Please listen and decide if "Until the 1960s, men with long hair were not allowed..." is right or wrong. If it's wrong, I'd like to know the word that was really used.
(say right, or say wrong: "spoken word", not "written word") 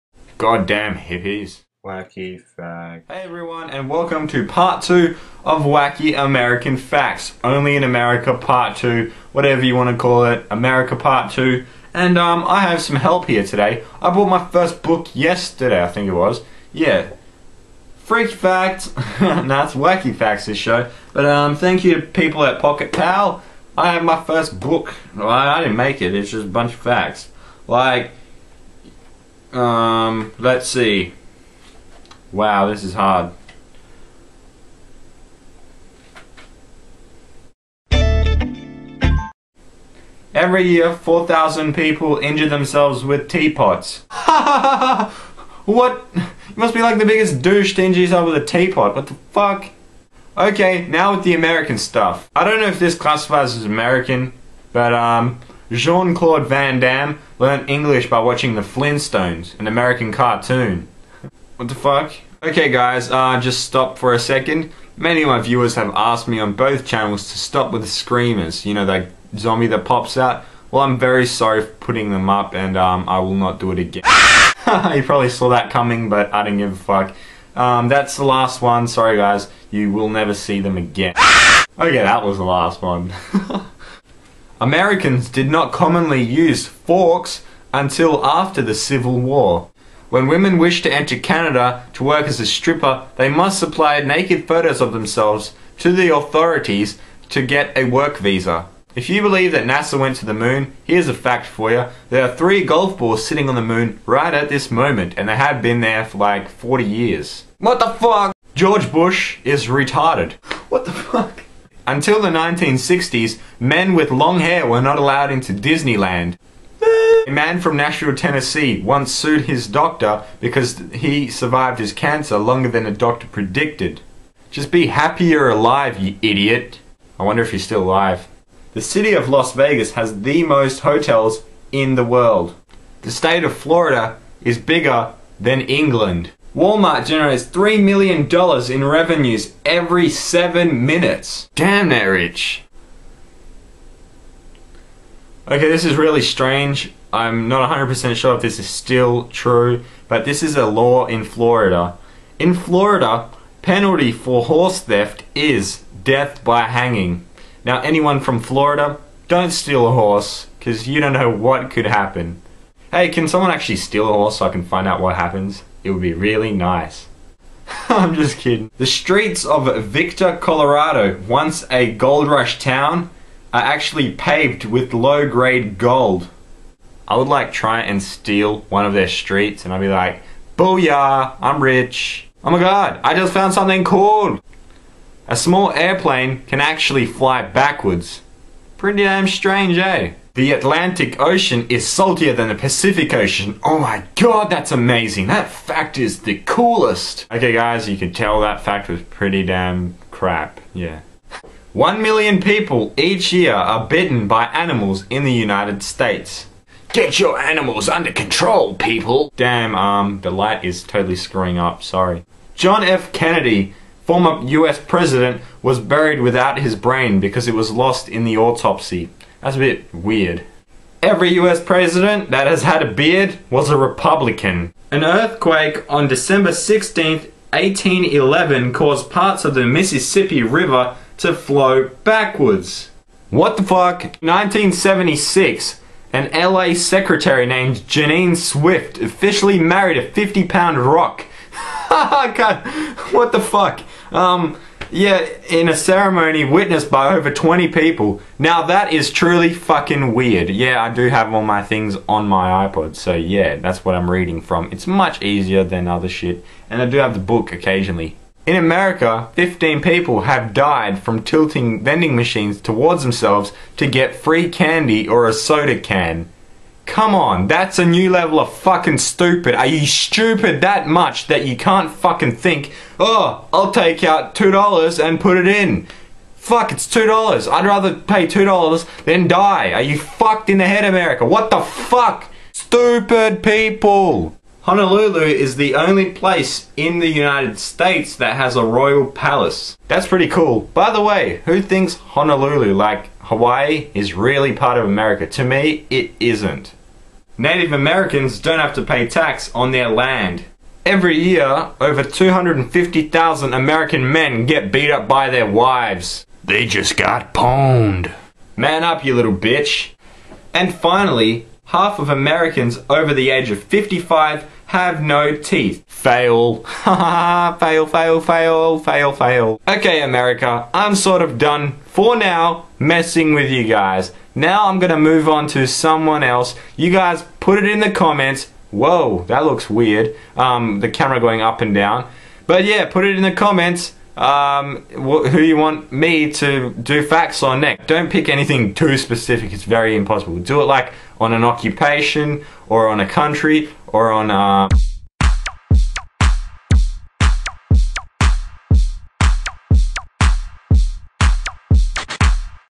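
right.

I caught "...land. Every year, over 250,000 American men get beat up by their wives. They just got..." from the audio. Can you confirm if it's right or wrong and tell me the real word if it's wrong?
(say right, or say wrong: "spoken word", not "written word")
right.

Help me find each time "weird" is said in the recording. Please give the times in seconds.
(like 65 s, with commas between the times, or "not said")
219 s, 250 s, 329 s.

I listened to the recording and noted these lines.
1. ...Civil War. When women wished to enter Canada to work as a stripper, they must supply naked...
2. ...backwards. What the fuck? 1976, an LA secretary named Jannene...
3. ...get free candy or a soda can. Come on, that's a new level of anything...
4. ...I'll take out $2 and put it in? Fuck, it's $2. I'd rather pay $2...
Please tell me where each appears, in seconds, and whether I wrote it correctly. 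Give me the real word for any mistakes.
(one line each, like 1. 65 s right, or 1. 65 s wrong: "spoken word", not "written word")
1. 88 s right
2. 232 s right
3. 263 s wrong: "fucking", not "anything"
4. 273 s right.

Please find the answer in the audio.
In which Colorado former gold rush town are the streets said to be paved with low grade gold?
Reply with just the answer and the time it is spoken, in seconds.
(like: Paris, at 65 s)
Victor, at 169 s.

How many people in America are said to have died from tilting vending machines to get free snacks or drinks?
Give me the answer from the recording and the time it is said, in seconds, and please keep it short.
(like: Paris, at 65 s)
15, at 259 s.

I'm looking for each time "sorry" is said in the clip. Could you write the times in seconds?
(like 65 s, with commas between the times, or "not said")
71 s, 78 s, 211 s.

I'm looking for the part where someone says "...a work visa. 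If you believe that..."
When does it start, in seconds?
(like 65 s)
97 s.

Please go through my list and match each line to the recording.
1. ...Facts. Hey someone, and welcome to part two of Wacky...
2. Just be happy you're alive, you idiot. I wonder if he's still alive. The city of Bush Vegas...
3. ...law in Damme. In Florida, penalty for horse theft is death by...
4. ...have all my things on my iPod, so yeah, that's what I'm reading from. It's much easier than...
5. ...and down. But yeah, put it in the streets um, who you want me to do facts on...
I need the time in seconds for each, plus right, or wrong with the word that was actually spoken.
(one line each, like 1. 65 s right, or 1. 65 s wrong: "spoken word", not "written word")
1. 2 s wrong: "everyone", not "someone"
2. 124 s wrong: "Las", not "Bush"
3. 150 s wrong: "Florida", not "Damme"
4. 251 s right
5. 331 s wrong: "comments", not "streets".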